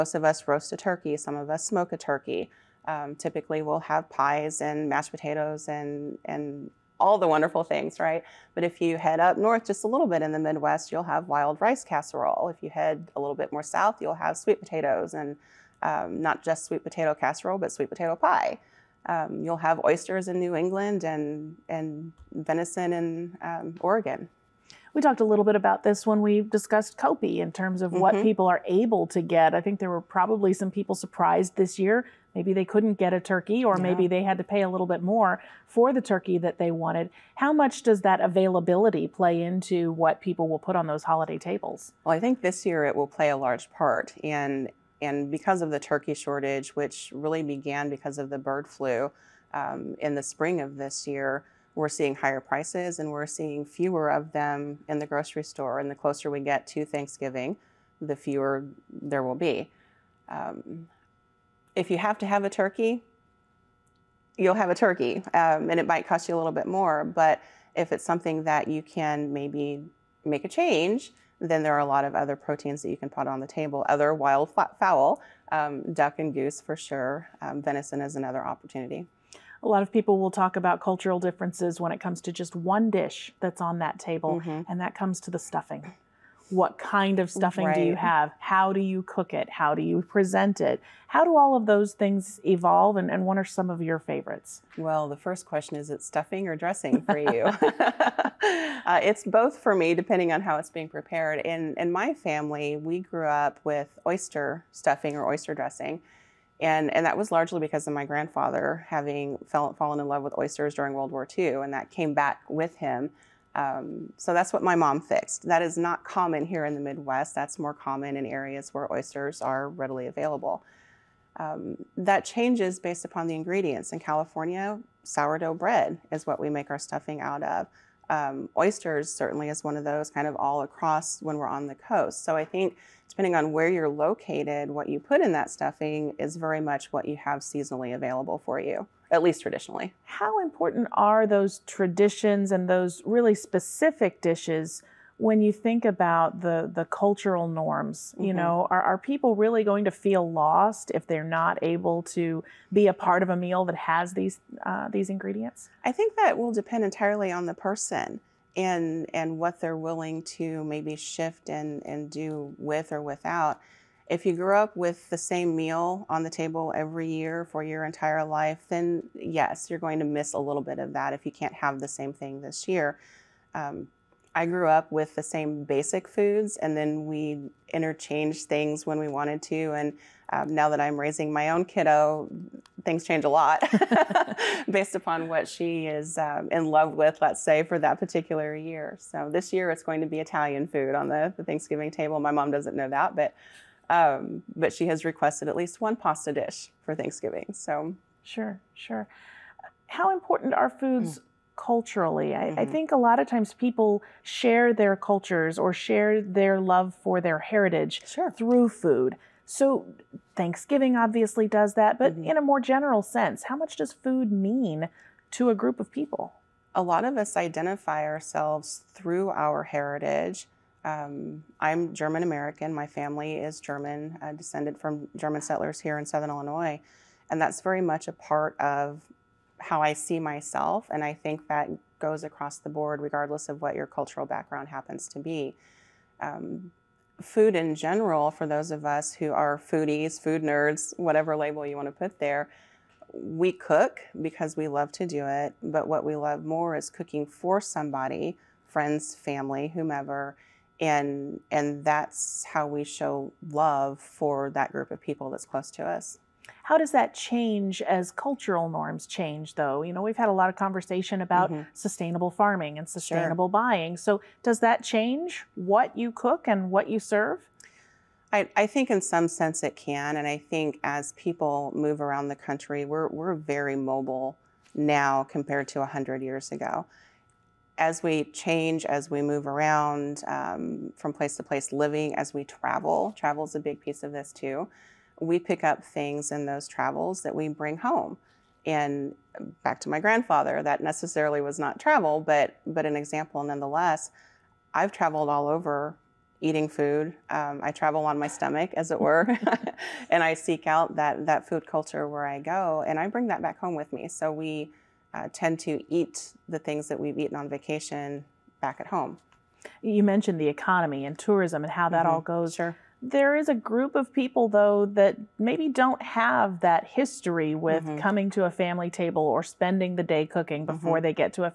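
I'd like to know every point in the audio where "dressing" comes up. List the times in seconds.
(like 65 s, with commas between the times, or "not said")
96 s, 105 s.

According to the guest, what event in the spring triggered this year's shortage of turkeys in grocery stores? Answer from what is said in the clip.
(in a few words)
bird flu.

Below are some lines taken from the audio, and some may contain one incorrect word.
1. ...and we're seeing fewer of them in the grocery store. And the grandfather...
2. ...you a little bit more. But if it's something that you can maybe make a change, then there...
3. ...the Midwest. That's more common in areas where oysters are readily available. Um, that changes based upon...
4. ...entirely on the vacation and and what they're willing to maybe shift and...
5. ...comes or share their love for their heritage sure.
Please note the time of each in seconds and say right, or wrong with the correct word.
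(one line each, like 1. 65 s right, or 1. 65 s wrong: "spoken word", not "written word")
1. 52 s wrong: "closer", not "grandfather"
2. 66 s right
3. 116 s right
4. 156 s wrong: "person", not "vacation"
5. 204 s wrong: "cultures", not "comes".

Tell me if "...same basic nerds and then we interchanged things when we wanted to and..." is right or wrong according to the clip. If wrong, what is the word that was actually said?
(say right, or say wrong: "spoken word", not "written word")
wrong: "foods", not "nerds".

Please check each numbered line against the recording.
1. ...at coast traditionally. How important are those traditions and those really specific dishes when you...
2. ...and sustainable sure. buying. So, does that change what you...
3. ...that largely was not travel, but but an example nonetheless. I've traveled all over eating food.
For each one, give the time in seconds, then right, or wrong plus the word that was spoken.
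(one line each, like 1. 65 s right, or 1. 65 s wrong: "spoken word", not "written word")
1. 139 s wrong: "least", not "coast"
2. 262 s right
3. 290 s wrong: "necessarily", not "largely".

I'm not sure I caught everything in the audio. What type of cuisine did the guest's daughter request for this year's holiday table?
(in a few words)
Italian.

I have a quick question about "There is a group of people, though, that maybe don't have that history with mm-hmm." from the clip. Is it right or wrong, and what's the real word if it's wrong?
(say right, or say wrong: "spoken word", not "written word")
right.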